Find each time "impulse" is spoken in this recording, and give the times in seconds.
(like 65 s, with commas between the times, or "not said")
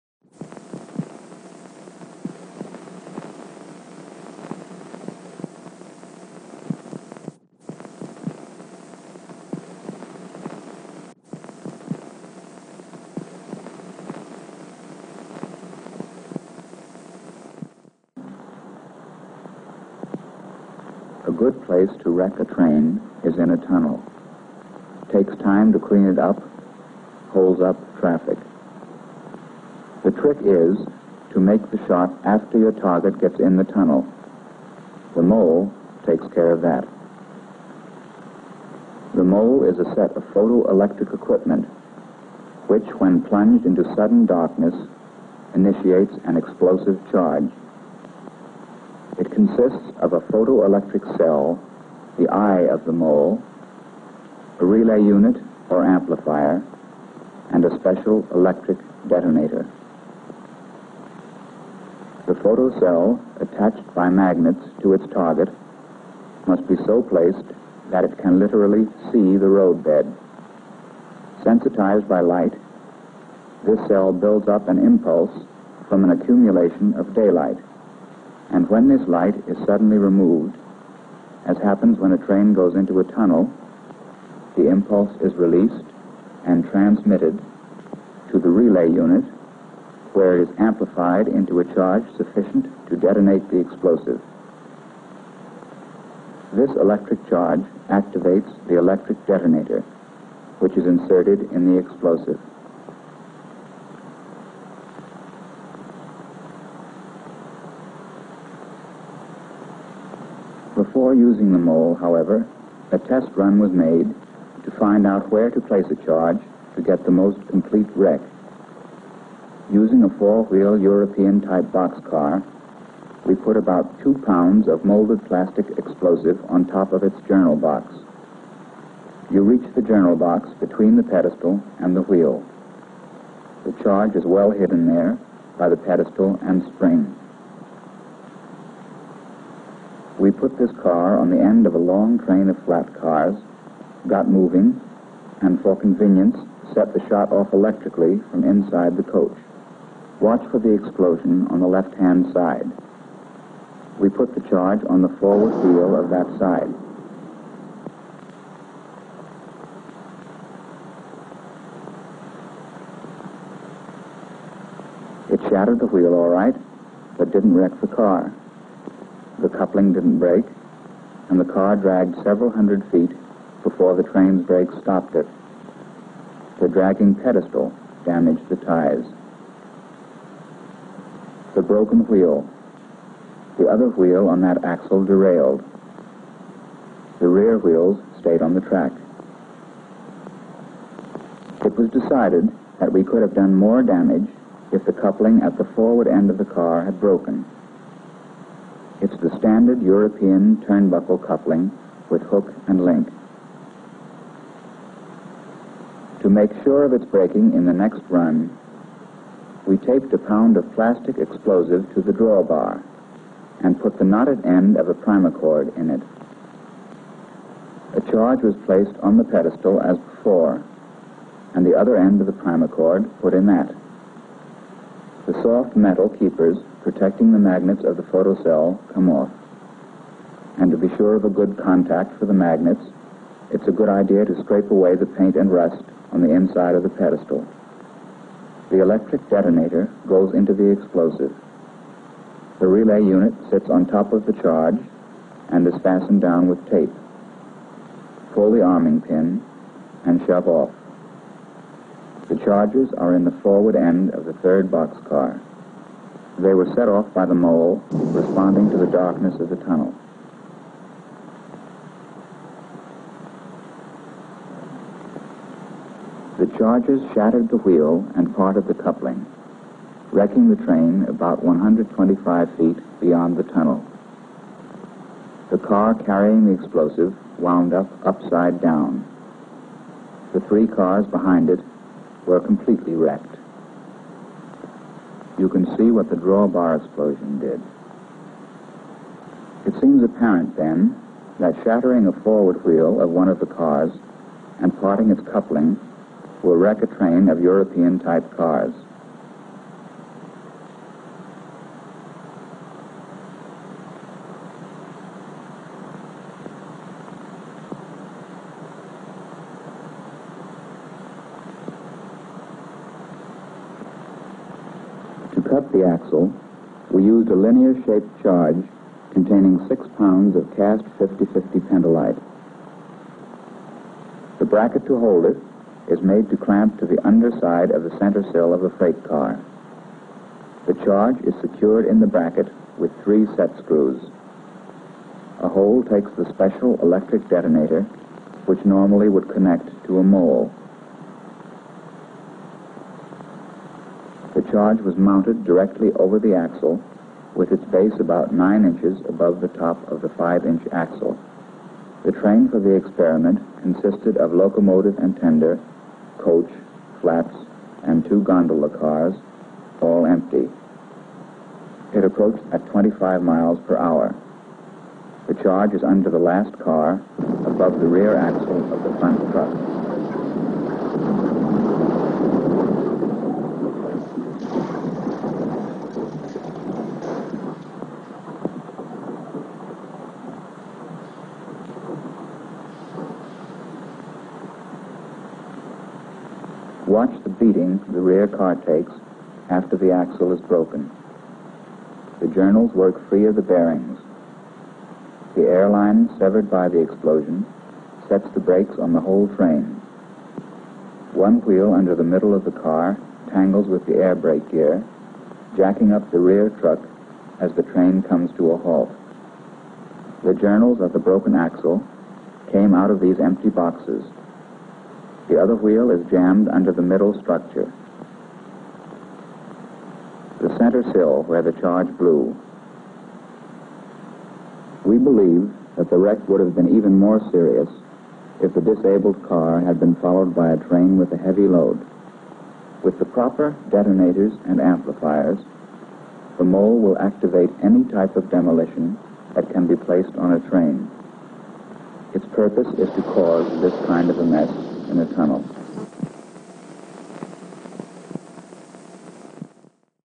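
74 s, 84 s.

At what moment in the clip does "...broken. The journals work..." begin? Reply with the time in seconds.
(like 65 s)
390 s.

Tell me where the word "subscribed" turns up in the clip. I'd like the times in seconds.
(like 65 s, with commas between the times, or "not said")
not said.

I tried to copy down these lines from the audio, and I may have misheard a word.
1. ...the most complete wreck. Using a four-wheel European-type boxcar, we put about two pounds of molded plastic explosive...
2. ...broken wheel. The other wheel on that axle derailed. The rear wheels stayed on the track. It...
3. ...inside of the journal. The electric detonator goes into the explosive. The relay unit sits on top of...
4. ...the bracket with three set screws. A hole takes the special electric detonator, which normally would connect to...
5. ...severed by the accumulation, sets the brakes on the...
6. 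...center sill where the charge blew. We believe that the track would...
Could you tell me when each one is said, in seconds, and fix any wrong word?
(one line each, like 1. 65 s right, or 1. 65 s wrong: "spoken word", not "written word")
1. 117 s right
2. 181 s right
3. 236 s wrong: "pedestal", not "journal"
4. 331 s right
5. 396 s wrong: "explosion", not "accumulation"
6. 420 s wrong: "wreck", not "track".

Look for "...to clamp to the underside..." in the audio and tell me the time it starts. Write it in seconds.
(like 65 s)
326 s.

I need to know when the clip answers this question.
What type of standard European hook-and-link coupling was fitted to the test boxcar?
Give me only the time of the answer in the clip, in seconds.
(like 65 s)
200 s.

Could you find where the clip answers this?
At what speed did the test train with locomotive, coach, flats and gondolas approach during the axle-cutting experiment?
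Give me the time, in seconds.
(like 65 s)
362 s.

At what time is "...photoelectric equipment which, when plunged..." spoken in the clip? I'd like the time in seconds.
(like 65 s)
40 s.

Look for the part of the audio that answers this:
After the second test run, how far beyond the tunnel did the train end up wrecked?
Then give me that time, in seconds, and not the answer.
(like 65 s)
271 s.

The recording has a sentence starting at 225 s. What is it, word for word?
The soft metal keepers protecting the magnets of the photocell come off.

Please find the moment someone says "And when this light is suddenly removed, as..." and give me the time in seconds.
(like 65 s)
78 s.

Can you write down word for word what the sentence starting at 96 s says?
This electric charge activates the electric detonator, which is inserted in the explosive.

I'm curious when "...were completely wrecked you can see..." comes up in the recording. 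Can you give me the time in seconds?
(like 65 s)
282 s.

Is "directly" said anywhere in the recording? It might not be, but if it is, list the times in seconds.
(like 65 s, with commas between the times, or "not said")
345 s.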